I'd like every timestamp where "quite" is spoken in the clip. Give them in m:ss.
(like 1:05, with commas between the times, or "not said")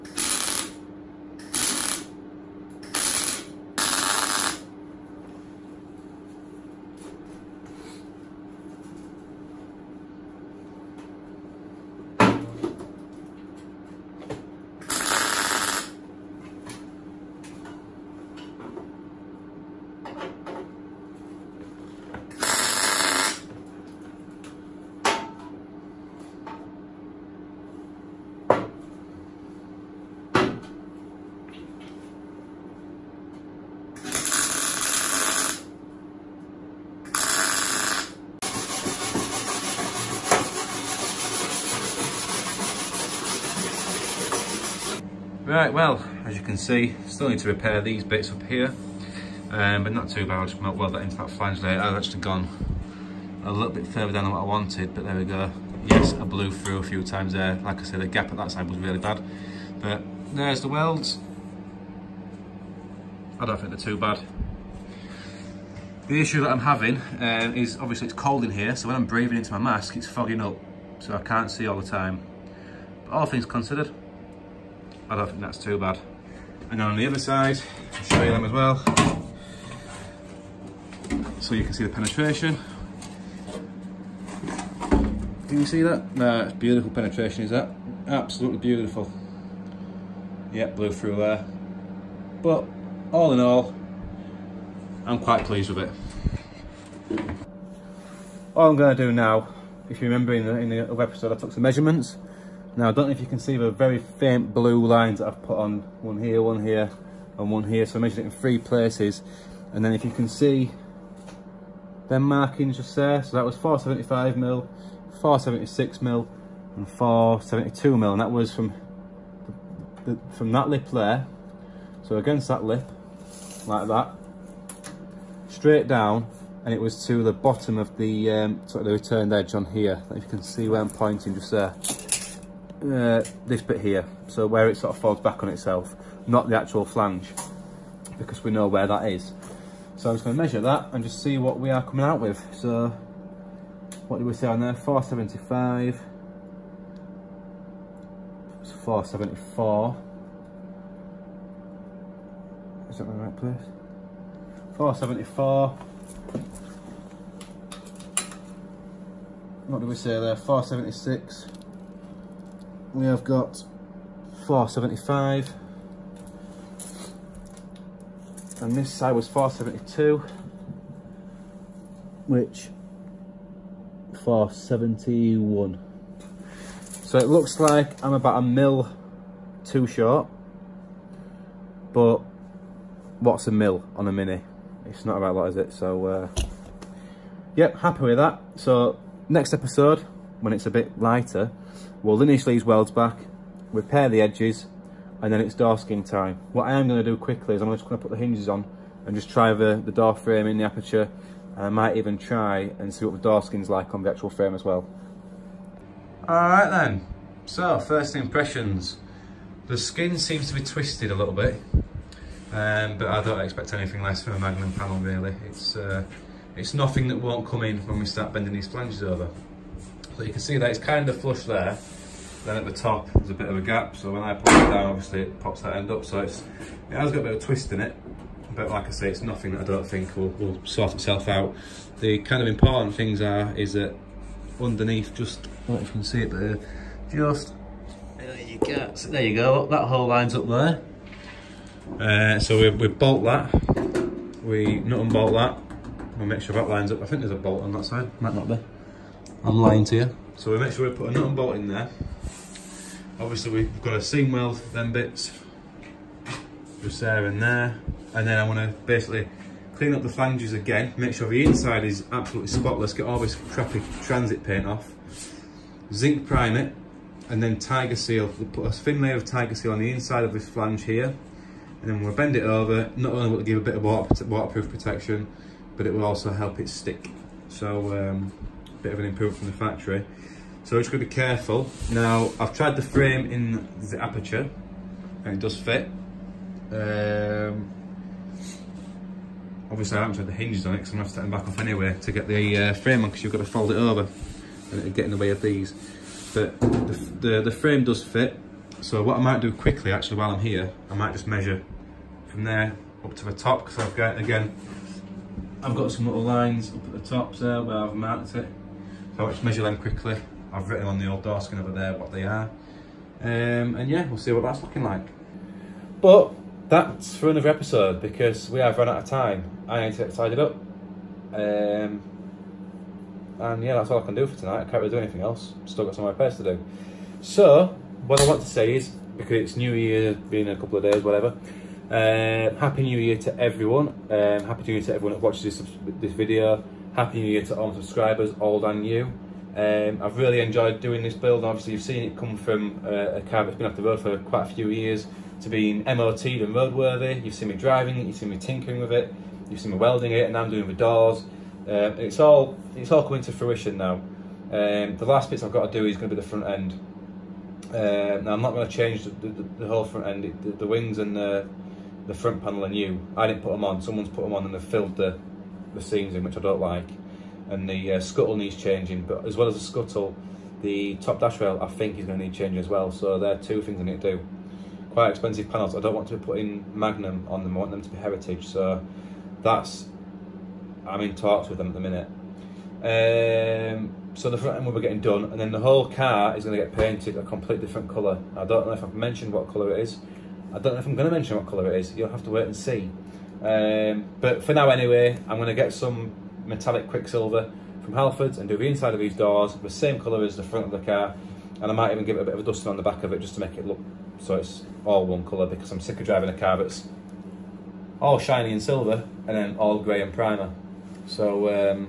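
1:35, 5:44, 6:14.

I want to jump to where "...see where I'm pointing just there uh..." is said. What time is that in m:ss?
2:10.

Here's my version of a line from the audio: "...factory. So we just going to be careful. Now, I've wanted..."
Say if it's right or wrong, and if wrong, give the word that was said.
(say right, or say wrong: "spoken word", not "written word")
wrong: "tried", not "wanted".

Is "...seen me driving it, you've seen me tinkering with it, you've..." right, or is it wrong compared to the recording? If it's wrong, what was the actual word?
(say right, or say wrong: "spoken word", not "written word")
right.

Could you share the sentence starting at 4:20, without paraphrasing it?
Make sure the inside is absolutely spotless.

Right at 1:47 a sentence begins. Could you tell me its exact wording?
So I measured it in three places.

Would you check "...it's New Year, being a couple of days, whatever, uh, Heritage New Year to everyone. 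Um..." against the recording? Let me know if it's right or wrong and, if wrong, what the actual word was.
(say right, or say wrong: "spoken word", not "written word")
wrong: "Happy", not "Heritage".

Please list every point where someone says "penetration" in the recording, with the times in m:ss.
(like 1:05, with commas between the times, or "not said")
1:21, 1:26.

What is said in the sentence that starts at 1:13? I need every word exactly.
But all things considered, I don't think that's too bad.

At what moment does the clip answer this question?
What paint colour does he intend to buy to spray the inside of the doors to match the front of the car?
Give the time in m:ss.
6:36.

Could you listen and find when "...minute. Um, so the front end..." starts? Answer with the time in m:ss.
6:21.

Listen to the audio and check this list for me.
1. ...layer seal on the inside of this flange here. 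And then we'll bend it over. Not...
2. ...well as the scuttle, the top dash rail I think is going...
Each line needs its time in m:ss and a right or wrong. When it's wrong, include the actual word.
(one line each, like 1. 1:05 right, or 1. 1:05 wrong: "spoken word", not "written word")
1. 4:29 wrong: "tiger", not "layer"
2. 6:09 right.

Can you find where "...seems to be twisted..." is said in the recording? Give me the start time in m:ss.
3:30.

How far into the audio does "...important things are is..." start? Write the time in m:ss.
3:52.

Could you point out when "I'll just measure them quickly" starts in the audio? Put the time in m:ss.
5:09.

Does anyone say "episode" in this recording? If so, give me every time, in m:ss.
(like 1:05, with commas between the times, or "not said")
1:41, 3:09, 5:17.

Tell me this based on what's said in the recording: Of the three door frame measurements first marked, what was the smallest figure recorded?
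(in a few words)
472 mm.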